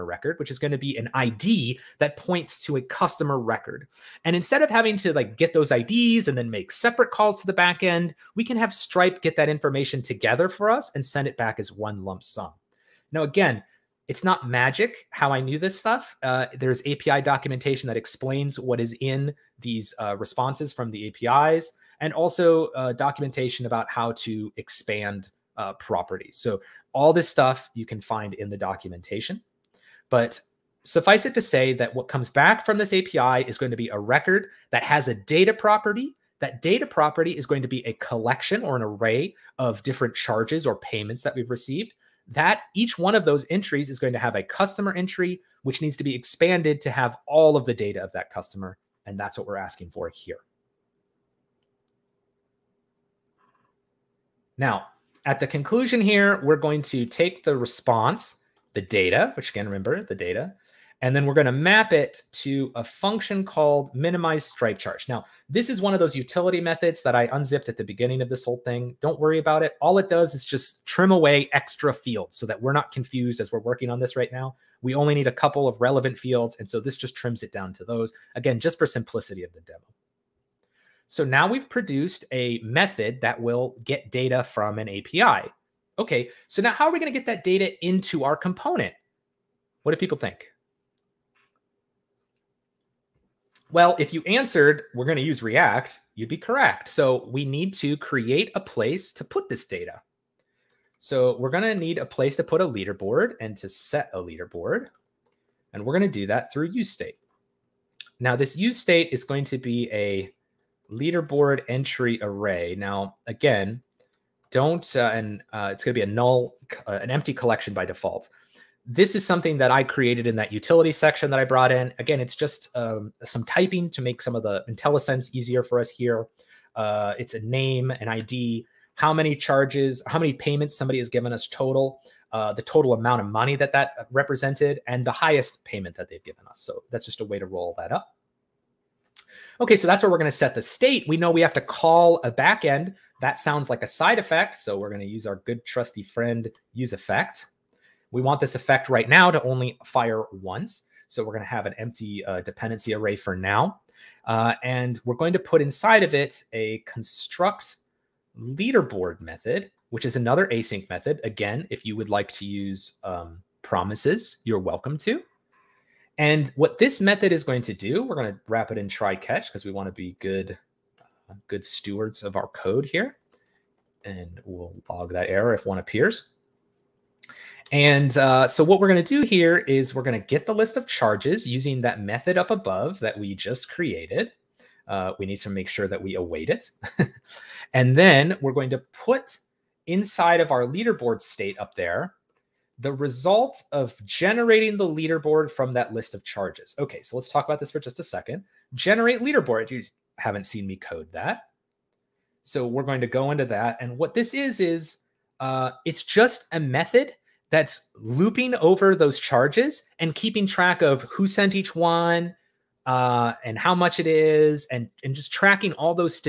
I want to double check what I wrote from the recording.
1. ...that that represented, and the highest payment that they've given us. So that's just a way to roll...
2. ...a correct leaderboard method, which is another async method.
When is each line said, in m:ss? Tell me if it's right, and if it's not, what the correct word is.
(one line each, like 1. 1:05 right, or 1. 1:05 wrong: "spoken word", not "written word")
1. 2:13 right
2. 2:36 wrong: "construct", not "correct".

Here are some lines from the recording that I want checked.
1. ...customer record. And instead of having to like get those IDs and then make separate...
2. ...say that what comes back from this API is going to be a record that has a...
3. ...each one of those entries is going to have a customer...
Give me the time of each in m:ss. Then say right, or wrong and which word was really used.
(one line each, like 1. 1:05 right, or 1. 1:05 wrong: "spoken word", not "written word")
1. 0:02 right
2. 0:31 right
3. 0:42 right.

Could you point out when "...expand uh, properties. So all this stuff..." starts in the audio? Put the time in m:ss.
0:24.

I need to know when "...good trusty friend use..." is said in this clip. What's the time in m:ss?
2:25.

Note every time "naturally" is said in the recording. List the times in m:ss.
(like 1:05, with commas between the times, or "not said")
not said.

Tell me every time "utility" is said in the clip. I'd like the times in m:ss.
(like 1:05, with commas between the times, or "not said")
1:06, 2:00.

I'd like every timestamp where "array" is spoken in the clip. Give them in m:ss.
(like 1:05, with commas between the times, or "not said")
0:38, 1:52, 2:32.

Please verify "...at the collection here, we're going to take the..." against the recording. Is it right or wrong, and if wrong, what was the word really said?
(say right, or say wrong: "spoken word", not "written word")
wrong: "conclusion", not "collection".